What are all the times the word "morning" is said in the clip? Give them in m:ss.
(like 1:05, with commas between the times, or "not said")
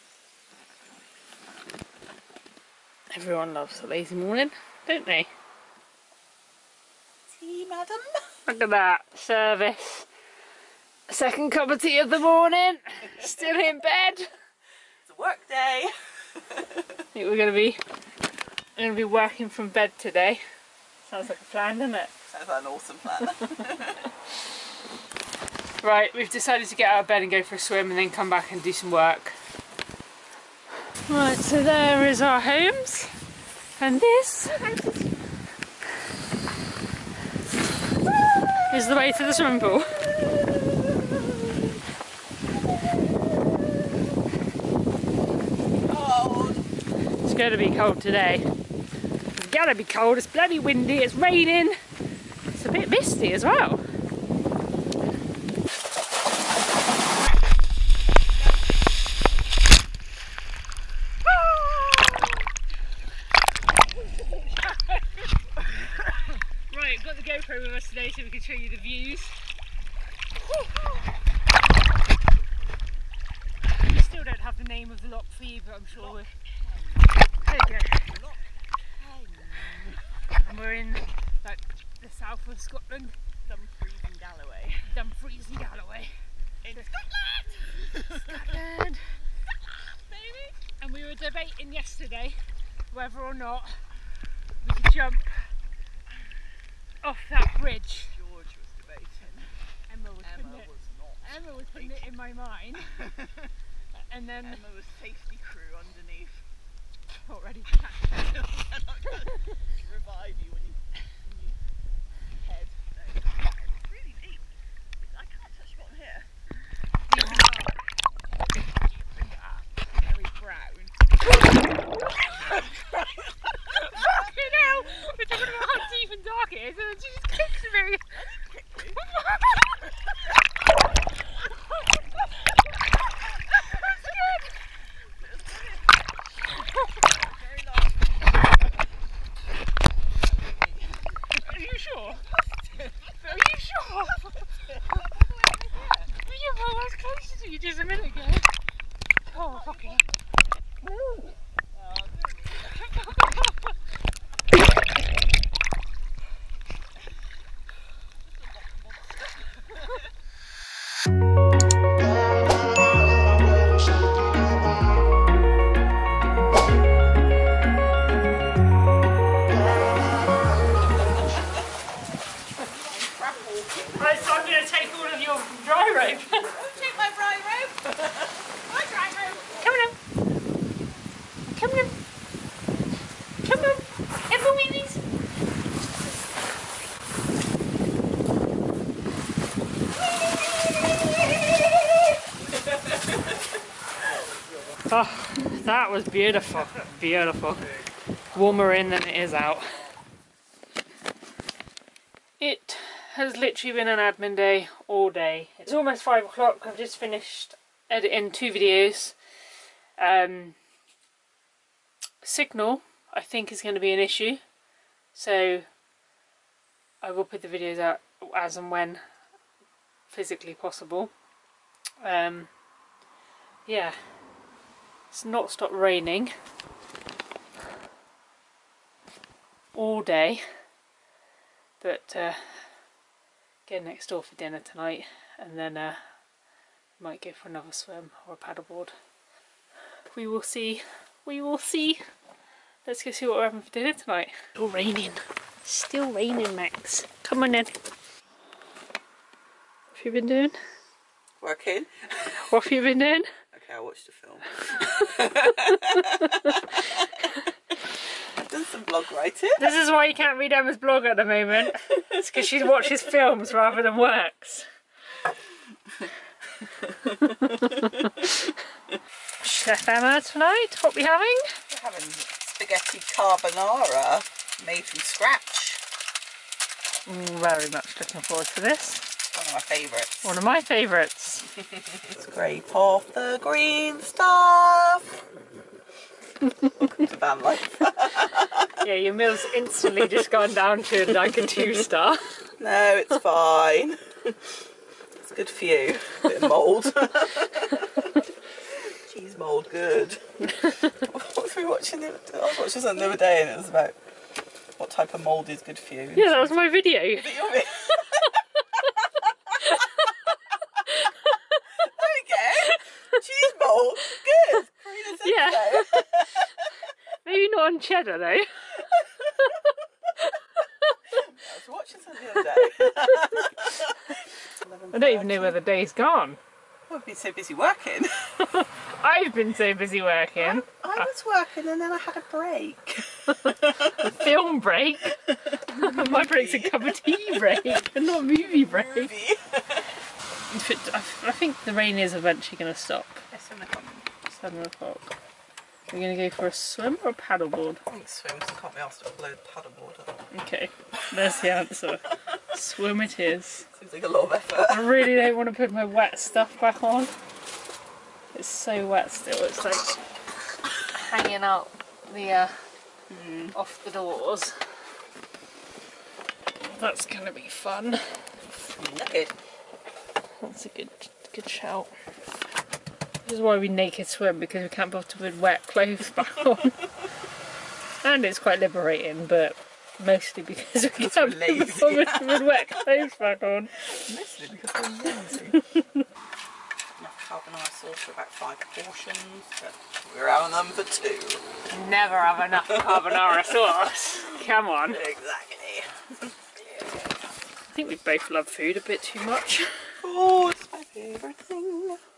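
0:04, 0:12.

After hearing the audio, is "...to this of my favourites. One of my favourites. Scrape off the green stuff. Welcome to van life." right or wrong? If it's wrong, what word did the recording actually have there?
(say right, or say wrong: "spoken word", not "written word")
right.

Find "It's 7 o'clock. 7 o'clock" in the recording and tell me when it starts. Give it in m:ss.
5:43.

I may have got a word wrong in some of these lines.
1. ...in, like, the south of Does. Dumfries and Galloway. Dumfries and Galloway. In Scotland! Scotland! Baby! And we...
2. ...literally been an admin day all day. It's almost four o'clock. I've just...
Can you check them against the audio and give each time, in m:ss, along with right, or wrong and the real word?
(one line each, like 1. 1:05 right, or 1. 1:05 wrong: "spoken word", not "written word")
1. 1:20 wrong: "Scotland", not "Does"
2. 3:23 wrong: "five", not "four".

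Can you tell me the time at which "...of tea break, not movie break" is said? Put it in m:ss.
5:36.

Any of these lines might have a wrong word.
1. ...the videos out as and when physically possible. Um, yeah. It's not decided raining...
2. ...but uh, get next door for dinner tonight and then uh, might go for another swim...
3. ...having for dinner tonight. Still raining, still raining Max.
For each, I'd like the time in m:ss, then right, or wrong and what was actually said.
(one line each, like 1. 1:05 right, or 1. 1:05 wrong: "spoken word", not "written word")
1. 3:37 wrong: "stopped", not "decided"
2. 3:51 right
3. 4:03 right.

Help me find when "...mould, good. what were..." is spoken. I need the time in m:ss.
4:59.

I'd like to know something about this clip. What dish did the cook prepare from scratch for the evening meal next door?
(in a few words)
Spaghetti carbonara.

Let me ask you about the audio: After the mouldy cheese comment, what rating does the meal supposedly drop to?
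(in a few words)
2 stars.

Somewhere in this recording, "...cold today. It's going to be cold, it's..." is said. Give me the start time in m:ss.
0:47.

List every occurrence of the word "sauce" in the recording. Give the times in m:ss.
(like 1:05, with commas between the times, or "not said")
6:27, 6:33.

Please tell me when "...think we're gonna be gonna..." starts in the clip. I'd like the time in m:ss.
0:16.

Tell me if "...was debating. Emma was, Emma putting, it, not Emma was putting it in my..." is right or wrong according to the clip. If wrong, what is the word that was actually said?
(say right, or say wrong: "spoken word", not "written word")
right.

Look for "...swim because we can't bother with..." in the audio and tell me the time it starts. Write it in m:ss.
6:14.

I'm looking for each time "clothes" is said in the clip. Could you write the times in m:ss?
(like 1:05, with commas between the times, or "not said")
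6:15, 6:22.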